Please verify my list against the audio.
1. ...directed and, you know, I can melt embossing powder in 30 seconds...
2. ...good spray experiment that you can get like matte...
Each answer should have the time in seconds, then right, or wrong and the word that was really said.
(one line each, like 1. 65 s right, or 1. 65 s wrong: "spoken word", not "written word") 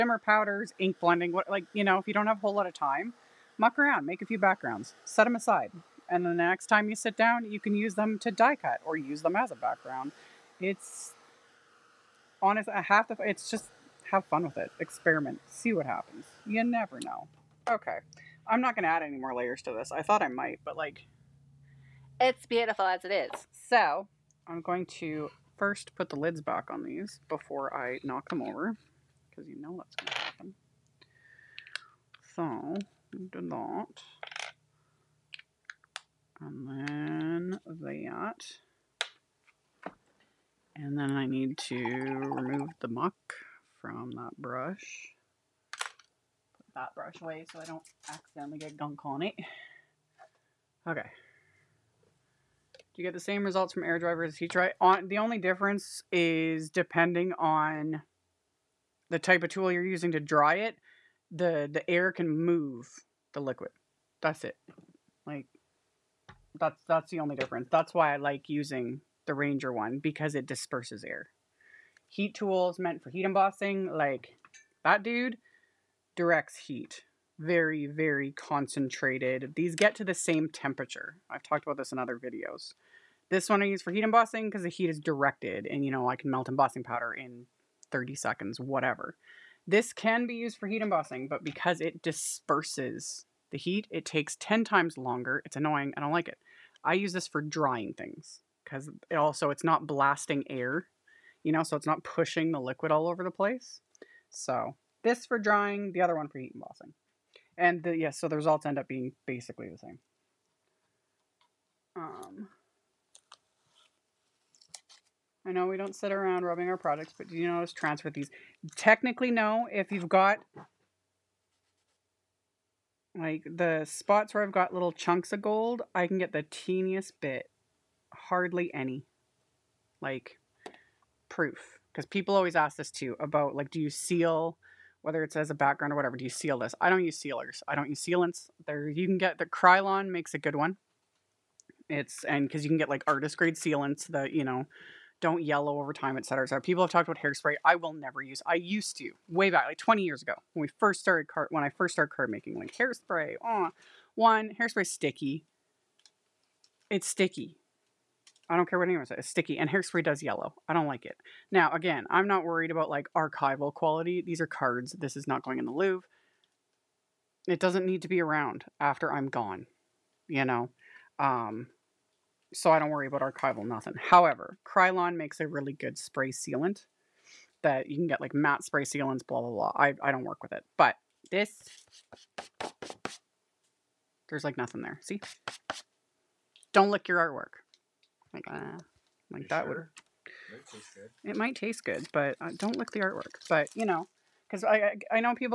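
1. 84 s right
2. 175 s wrong: "sealant", not "experiment".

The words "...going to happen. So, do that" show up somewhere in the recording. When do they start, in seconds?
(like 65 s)
29 s.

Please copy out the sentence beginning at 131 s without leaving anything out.
Because people always ask this too about like, do you seal, whether it's as a background or whatever, do you seal this?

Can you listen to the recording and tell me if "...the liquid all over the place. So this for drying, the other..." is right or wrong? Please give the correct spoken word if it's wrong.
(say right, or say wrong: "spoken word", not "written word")
right.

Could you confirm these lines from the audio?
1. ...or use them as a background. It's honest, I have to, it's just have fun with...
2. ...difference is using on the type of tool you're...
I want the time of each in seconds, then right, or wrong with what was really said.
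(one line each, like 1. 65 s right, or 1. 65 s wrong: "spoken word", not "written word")
1. 8 s right
2. 55 s wrong: "depending", not "using".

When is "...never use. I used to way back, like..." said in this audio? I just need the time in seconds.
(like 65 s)
147 s.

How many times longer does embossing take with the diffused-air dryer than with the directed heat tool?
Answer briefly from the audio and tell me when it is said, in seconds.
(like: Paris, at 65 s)
10 times, at 94 s.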